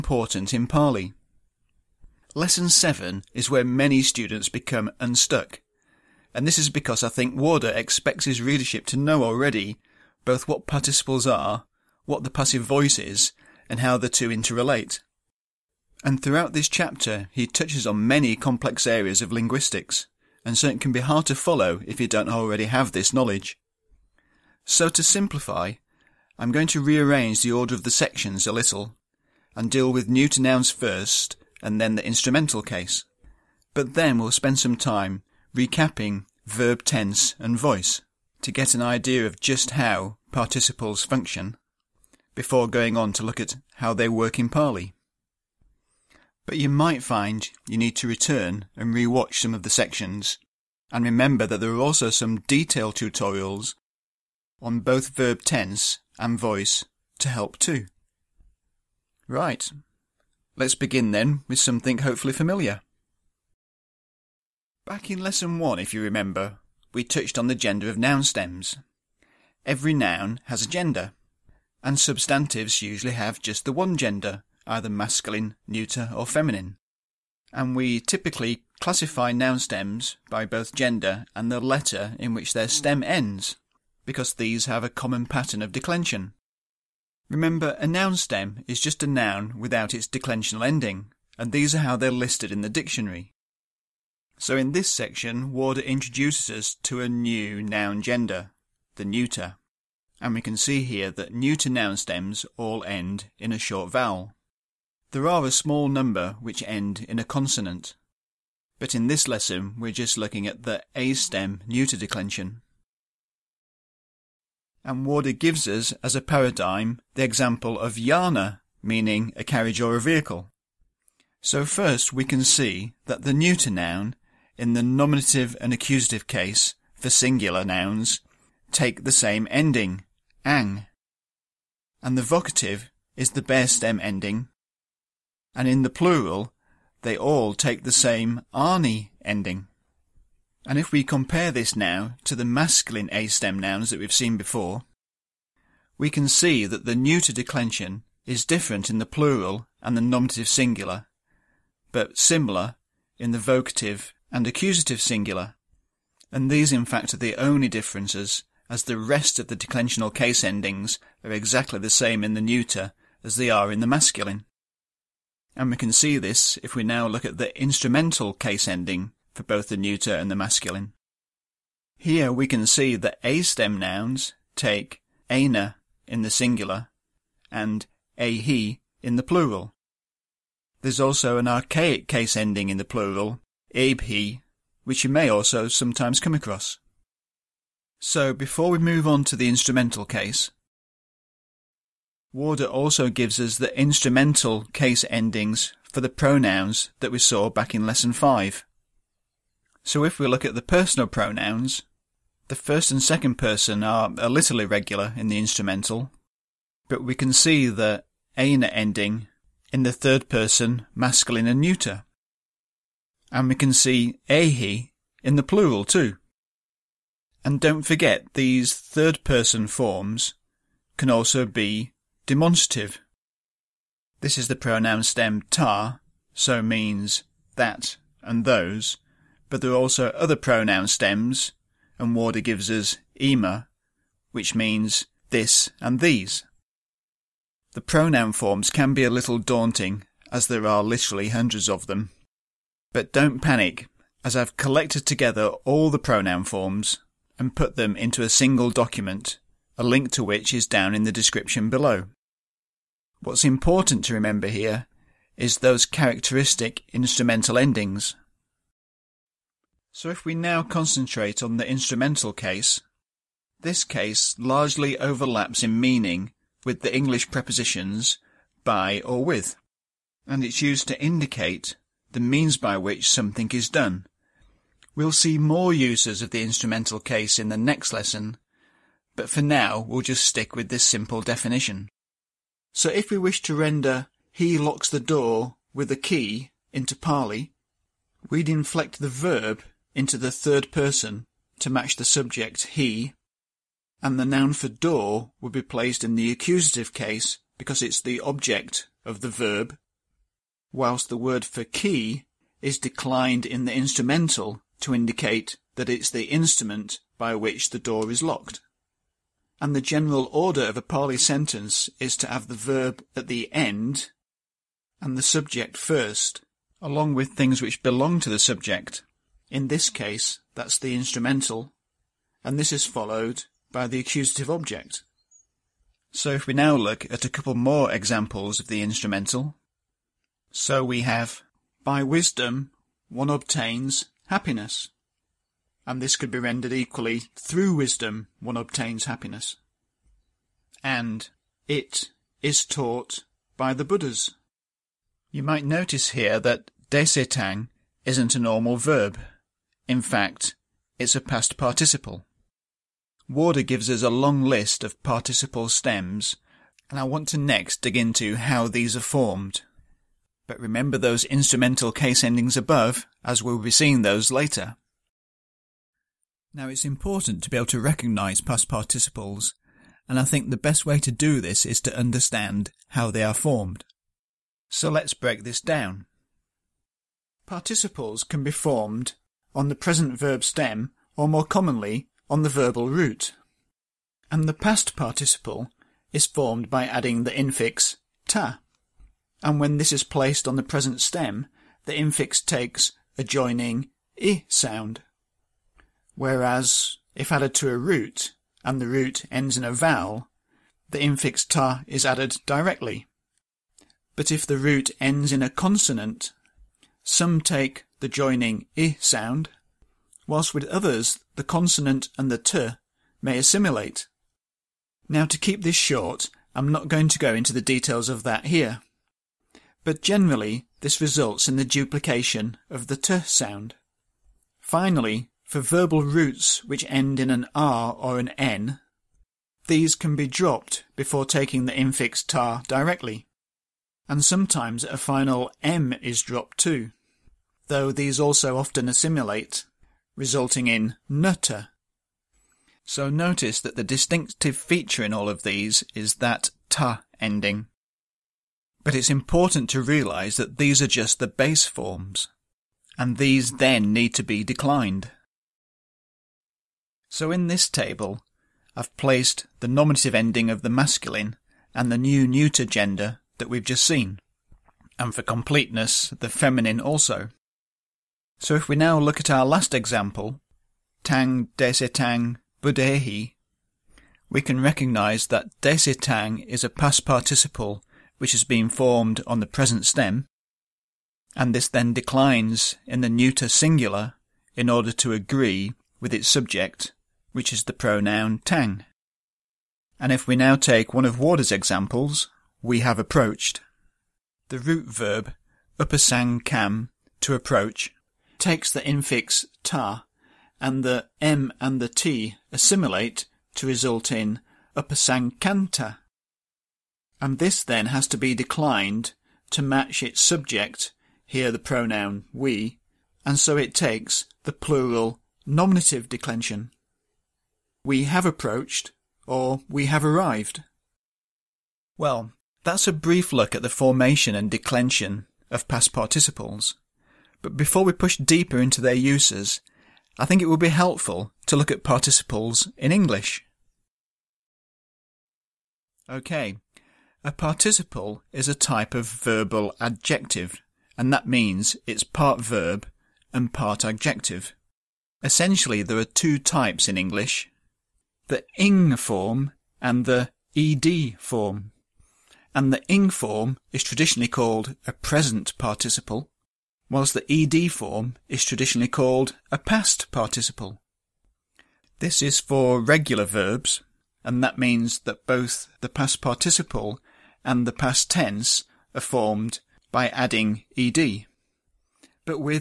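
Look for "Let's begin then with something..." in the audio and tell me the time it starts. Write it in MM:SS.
01:00.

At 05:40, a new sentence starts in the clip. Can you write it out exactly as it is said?
And it is taught by the Buddhas.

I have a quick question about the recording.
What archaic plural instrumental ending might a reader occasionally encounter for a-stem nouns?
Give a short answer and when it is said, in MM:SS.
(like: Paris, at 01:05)
abe-he, at 03:03.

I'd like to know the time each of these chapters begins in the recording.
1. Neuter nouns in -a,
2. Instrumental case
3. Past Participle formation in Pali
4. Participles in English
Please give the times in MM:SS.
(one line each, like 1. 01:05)
1. 00:59
2. 02:44
3. 06:05
4. 08:49.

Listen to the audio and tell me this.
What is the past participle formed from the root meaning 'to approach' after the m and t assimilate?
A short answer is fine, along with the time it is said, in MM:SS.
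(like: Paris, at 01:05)
upasankanta, at 08:24.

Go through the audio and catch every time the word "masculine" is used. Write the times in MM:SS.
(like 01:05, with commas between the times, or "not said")
01:14, 02:22, 02:43, 02:50, 03:30, 07:40.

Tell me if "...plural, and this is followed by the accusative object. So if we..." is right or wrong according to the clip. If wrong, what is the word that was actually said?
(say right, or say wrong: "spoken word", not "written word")
wrong: "instrumental", not "plural".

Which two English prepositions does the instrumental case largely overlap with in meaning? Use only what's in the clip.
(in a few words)
by or with.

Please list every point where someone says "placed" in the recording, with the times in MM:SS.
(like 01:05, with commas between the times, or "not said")
04:55, 06:30, 07:38.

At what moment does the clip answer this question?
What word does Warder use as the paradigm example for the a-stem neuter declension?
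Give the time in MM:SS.
01:57.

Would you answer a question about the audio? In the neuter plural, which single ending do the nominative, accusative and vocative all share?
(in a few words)
arni.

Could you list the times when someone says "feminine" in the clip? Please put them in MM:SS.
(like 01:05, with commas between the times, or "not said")
01:16, 07:46.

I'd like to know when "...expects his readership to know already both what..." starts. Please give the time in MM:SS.
00:07.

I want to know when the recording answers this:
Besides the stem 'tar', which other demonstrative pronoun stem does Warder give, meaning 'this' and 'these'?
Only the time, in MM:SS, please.
03:53.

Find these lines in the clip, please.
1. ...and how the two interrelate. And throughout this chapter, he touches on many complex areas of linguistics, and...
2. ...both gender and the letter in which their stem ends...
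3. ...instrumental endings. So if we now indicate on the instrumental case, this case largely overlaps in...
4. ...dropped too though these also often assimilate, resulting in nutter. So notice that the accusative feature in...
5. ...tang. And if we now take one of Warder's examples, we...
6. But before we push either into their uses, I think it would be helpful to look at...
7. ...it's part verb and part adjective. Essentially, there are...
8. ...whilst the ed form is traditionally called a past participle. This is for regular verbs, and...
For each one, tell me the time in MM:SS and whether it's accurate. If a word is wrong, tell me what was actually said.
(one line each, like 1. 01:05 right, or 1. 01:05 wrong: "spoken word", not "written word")
1. 00:13 right
2. 01:20 right
3. 04:16 wrong: "concentrate", not "indicate"
4. 07:16 wrong: "distinctive", not "accusative"
5. 08:08 right
6. 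08:47 wrong: "deeper", not "either"
7. 09:01 right
8. 09:16 right.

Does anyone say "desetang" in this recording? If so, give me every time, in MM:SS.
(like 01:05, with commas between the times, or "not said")
05:46, 07:51, 07:55.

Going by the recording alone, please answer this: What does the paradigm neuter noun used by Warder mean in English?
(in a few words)
a carriage or a vehicle.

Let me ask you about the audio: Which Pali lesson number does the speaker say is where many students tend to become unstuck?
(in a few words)
Lesson 7.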